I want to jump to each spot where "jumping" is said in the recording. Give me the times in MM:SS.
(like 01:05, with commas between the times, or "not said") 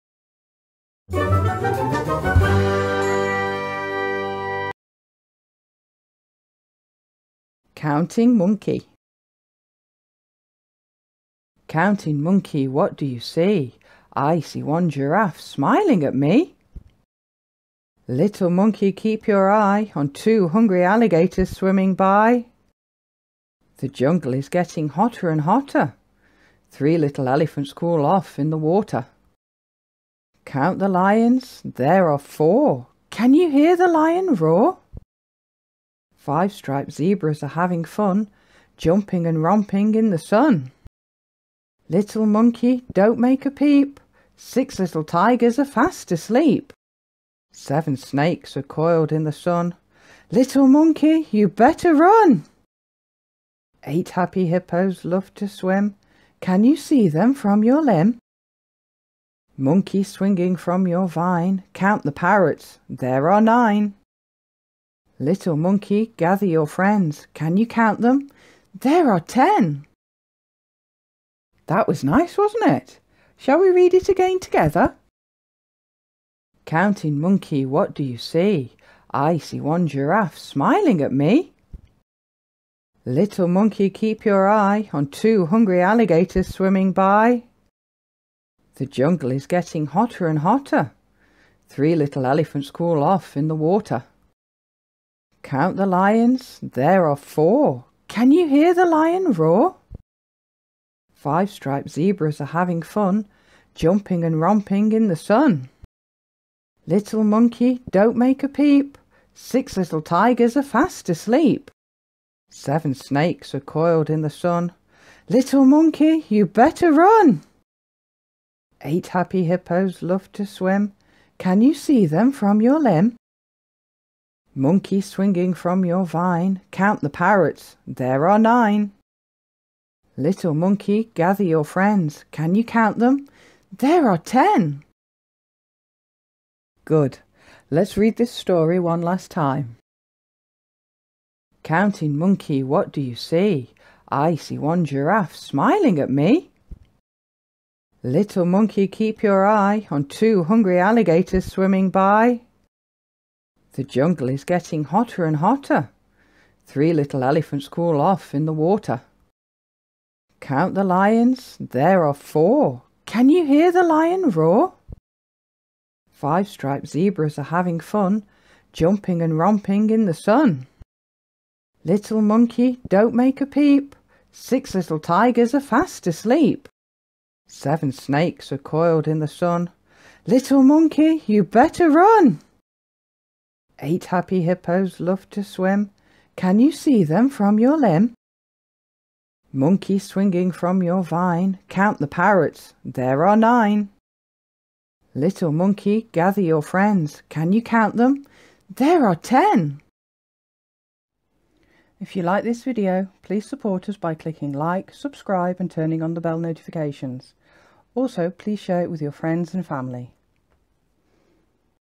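00:38, 01:43, 02:48.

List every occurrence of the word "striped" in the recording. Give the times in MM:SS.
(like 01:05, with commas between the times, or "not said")
00:36, 01:41, 02:46.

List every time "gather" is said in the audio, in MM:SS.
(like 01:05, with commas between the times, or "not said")
01:06, 02:11, 03:16.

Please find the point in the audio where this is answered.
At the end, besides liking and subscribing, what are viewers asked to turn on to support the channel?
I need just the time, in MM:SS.
03:26.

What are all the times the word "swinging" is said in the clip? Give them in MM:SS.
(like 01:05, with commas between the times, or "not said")
01:00, 02:05, 03:09.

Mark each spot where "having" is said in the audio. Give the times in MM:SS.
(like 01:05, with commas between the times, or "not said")
00:37, 01:42, 02:47.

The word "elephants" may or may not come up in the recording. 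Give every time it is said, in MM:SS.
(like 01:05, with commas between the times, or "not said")
00:27, 01:32, 02:37.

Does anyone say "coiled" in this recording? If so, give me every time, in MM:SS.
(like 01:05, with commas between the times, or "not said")
00:48, 01:53, 02:58.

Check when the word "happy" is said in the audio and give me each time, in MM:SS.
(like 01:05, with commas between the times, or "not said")
00:54, 01:59, 03:04.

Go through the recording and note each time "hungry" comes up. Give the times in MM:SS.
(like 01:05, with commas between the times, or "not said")
00:20, 01:25, 02:30.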